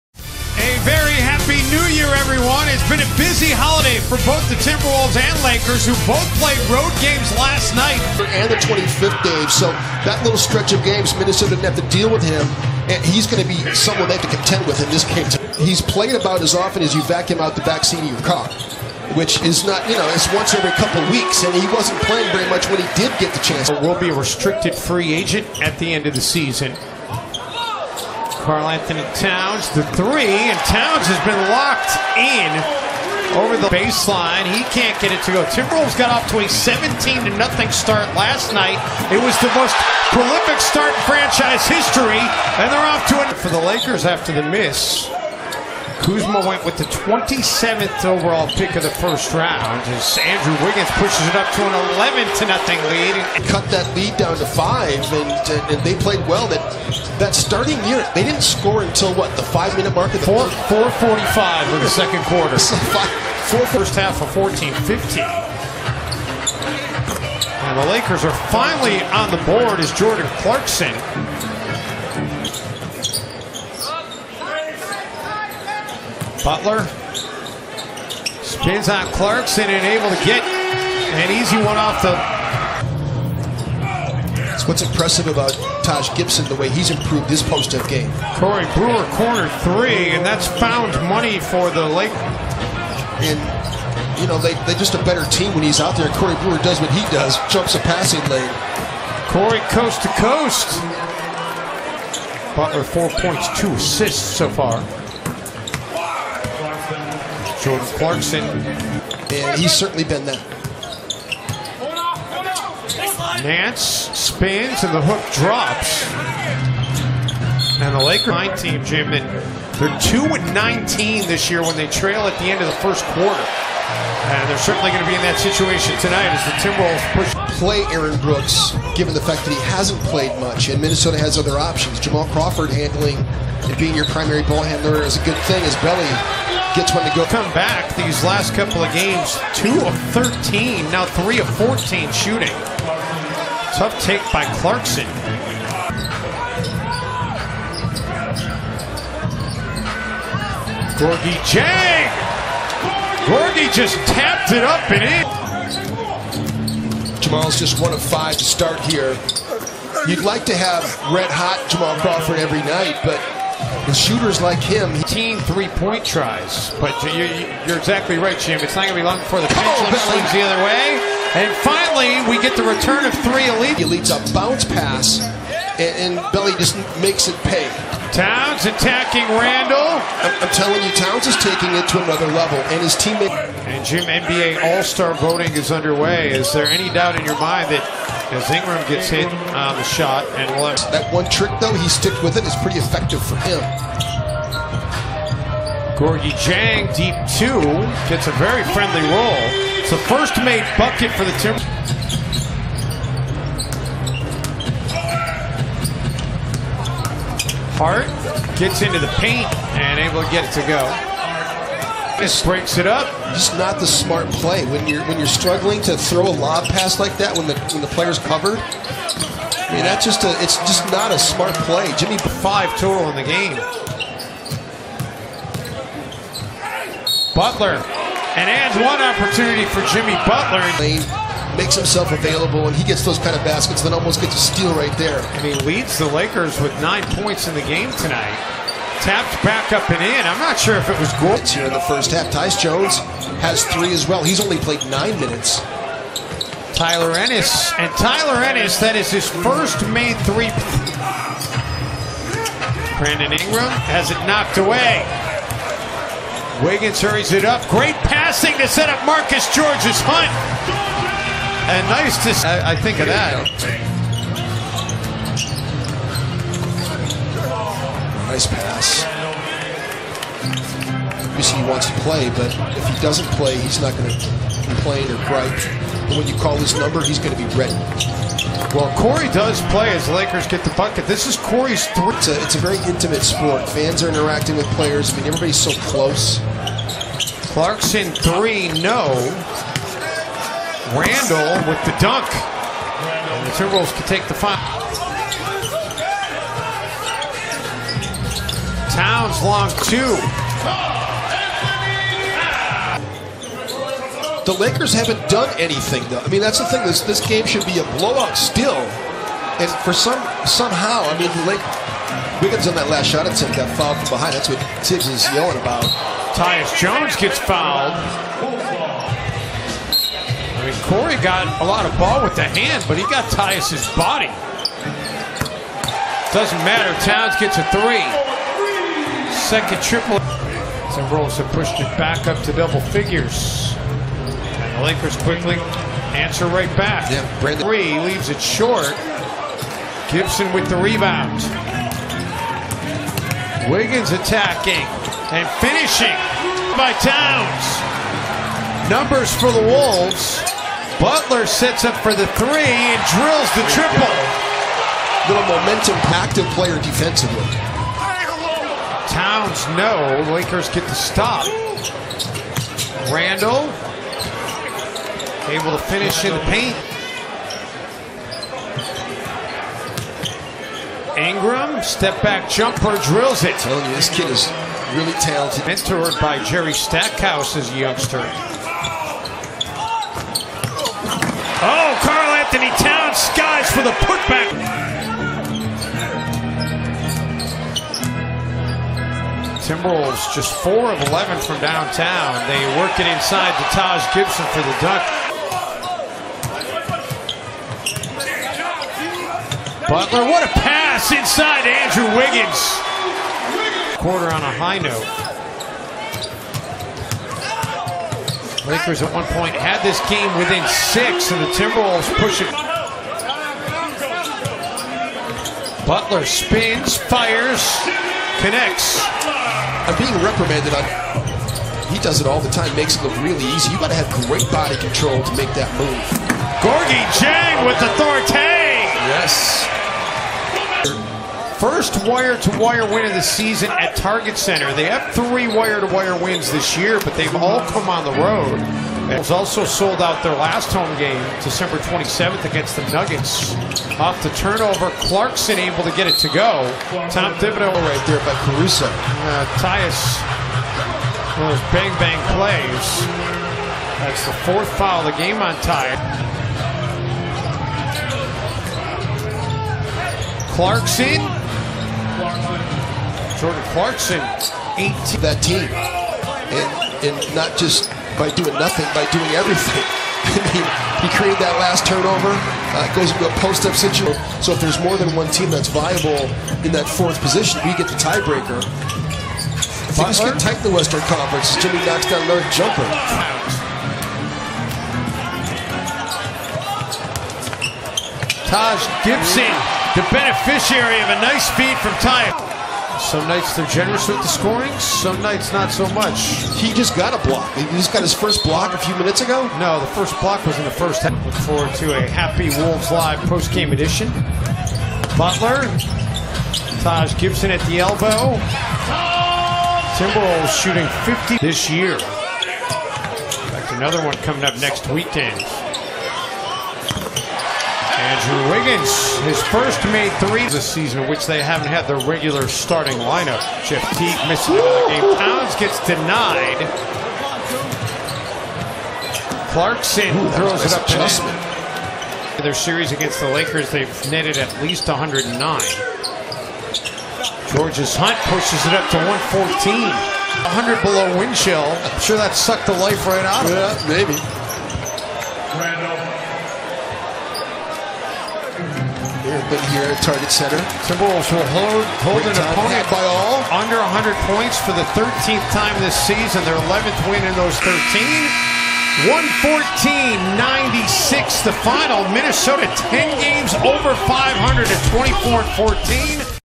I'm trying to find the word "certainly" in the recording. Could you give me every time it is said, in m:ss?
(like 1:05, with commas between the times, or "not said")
1:49, 2:04.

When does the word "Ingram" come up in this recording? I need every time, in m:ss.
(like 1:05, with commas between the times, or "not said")
3:08, 4:13, 6:11.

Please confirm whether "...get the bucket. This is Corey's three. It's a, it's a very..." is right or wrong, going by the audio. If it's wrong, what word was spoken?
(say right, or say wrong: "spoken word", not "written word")
right.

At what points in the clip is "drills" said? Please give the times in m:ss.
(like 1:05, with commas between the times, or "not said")
5:53, 6:13.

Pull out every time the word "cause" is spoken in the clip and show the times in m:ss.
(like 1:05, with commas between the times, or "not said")
not said.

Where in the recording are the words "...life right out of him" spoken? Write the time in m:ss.
9:02.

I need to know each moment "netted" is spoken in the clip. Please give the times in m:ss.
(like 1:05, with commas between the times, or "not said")
8:54.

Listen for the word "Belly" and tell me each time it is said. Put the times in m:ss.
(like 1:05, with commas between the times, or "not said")
2:15, 2:56.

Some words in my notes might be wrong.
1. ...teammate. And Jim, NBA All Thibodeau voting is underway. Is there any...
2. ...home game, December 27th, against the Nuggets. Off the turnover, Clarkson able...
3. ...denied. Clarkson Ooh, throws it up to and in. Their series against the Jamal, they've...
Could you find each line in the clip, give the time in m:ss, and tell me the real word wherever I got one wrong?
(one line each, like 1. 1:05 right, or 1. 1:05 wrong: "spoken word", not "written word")
1. 3:02 wrong: "Star", not "Thibodeau"
2. 7:20 right
3. 8:45 wrong: "Lakers", not "Jamal".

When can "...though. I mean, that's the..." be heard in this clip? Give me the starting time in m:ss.
5:06.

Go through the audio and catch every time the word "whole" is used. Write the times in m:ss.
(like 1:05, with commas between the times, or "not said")
not said.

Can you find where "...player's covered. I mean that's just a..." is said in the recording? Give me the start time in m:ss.
3:37.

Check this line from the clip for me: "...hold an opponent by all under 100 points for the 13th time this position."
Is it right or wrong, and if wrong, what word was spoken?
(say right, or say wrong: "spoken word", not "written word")
wrong: "season", not "position".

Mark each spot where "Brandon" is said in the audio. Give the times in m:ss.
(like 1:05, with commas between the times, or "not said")
4:12, 5:37.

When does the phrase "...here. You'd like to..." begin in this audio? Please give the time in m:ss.
2:38.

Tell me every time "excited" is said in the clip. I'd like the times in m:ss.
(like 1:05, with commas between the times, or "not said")
not said.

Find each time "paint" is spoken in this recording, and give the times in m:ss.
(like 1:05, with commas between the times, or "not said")
3:29, 6:06.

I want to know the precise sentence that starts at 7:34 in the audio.
That's the fourth foul of the game on Tyus.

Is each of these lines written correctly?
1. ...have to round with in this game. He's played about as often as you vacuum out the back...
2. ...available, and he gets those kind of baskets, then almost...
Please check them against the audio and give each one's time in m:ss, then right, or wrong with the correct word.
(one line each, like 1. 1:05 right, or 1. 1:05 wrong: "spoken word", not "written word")
1. 0:14 wrong: "contend", not "round"
2. 3:52 right.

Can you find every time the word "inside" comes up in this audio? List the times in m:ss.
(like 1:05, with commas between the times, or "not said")
6:33, 6:41.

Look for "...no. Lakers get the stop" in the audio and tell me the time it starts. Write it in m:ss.
5:59.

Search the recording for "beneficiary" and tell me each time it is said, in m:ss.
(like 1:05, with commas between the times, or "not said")
8:10.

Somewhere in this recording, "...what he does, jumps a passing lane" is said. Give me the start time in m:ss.
1:36.